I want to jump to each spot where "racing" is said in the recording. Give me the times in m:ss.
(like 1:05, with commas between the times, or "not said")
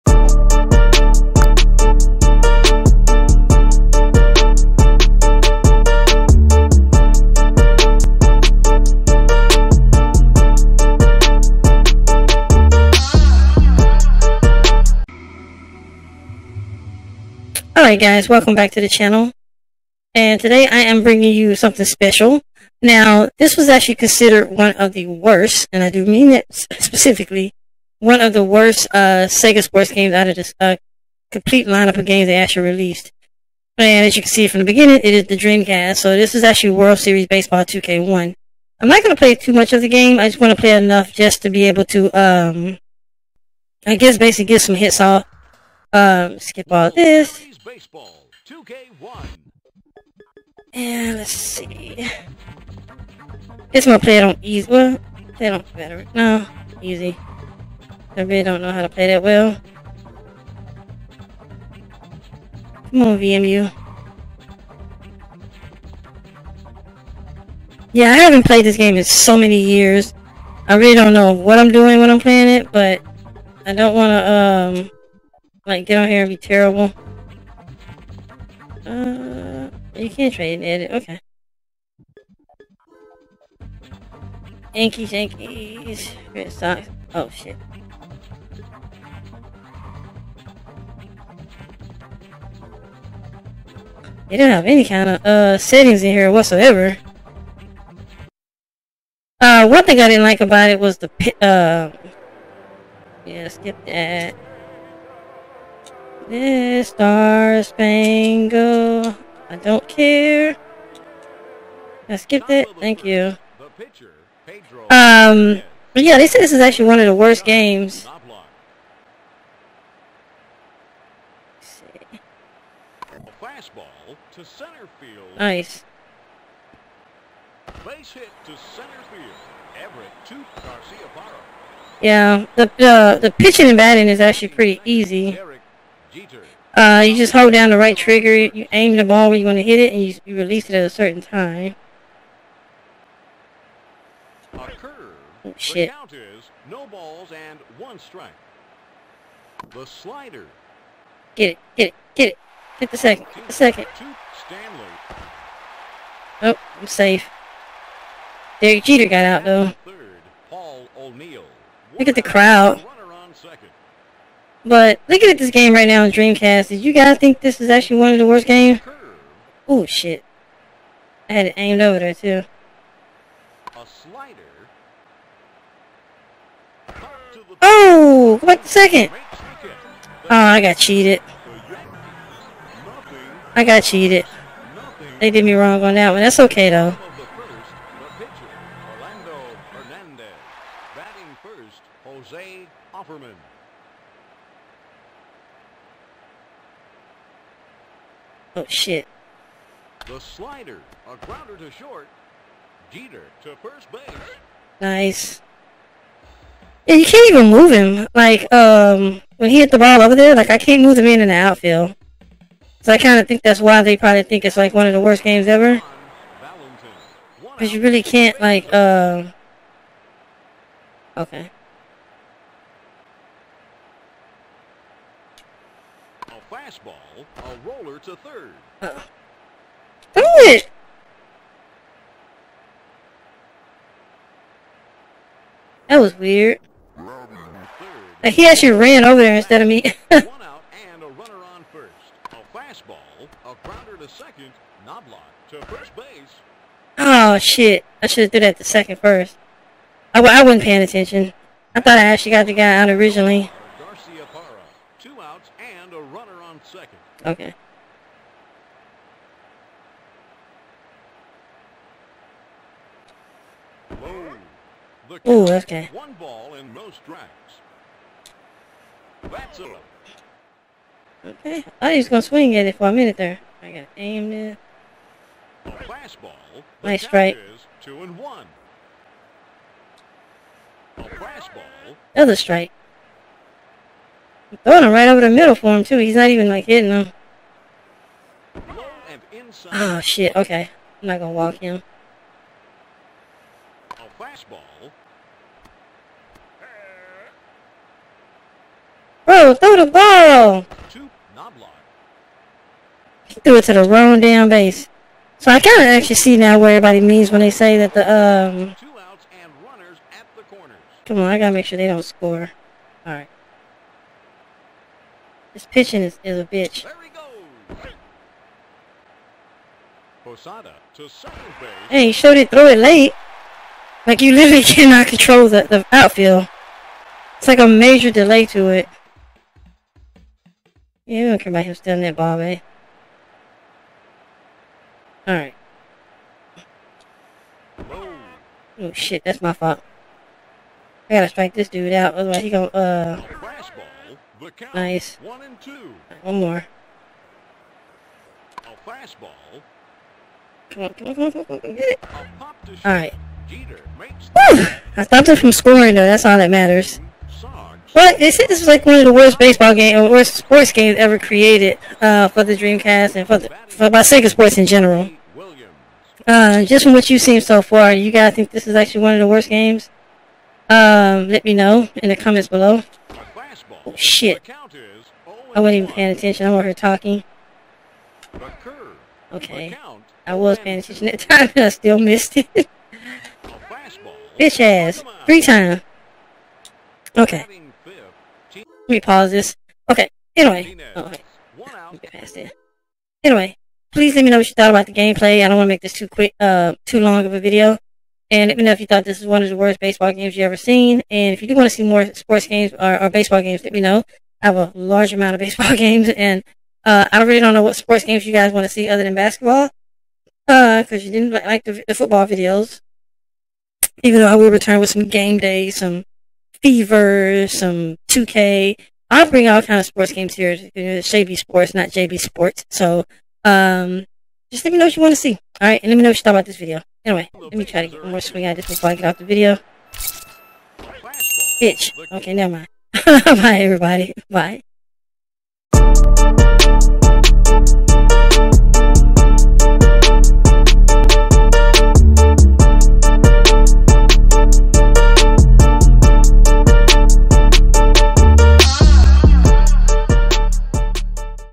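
not said.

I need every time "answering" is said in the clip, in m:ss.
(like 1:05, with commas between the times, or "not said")
not said.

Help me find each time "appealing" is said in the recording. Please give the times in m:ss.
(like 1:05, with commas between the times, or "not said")
not said.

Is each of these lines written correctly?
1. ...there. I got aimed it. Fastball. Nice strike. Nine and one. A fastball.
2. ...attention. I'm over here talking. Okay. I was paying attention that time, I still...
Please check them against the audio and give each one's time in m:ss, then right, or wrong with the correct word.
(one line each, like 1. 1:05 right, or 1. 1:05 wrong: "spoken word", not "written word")
1. 4:33 wrong: "Two", not "Nine"
2. 6:16 right.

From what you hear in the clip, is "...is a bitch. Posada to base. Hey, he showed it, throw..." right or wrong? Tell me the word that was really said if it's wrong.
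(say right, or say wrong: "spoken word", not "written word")
right.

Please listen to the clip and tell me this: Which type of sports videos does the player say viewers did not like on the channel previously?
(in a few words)
Football.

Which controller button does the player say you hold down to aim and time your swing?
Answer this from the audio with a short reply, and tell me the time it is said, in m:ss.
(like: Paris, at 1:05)
Right trigger, at 2:17.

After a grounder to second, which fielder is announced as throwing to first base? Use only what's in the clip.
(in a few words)
Knoblauch.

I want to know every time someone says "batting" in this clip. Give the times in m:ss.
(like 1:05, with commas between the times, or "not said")
2:13.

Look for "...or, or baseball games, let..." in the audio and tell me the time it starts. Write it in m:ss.
6:42.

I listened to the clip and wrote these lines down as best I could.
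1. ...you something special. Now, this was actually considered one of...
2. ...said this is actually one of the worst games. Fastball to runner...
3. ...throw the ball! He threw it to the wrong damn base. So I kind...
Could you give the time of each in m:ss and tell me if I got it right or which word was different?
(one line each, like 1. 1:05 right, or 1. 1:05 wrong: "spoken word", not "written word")
1. 0:21 right
2. 1:56 wrong: "center", not "runner"
3. 4:59 right.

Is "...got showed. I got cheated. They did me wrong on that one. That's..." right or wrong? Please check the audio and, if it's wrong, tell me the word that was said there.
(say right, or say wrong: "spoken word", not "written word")
wrong: "cheated", not "showed".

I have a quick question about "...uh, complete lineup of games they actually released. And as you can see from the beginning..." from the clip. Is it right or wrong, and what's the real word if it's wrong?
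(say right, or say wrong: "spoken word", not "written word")
right.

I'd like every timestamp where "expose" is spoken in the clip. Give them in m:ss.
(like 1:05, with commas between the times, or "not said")
not said.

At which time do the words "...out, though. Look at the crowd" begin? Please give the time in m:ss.
2:39.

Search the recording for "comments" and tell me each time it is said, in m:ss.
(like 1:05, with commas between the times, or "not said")
6:12.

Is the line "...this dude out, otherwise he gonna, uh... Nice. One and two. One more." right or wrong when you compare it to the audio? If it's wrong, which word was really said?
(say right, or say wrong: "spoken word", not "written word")
right.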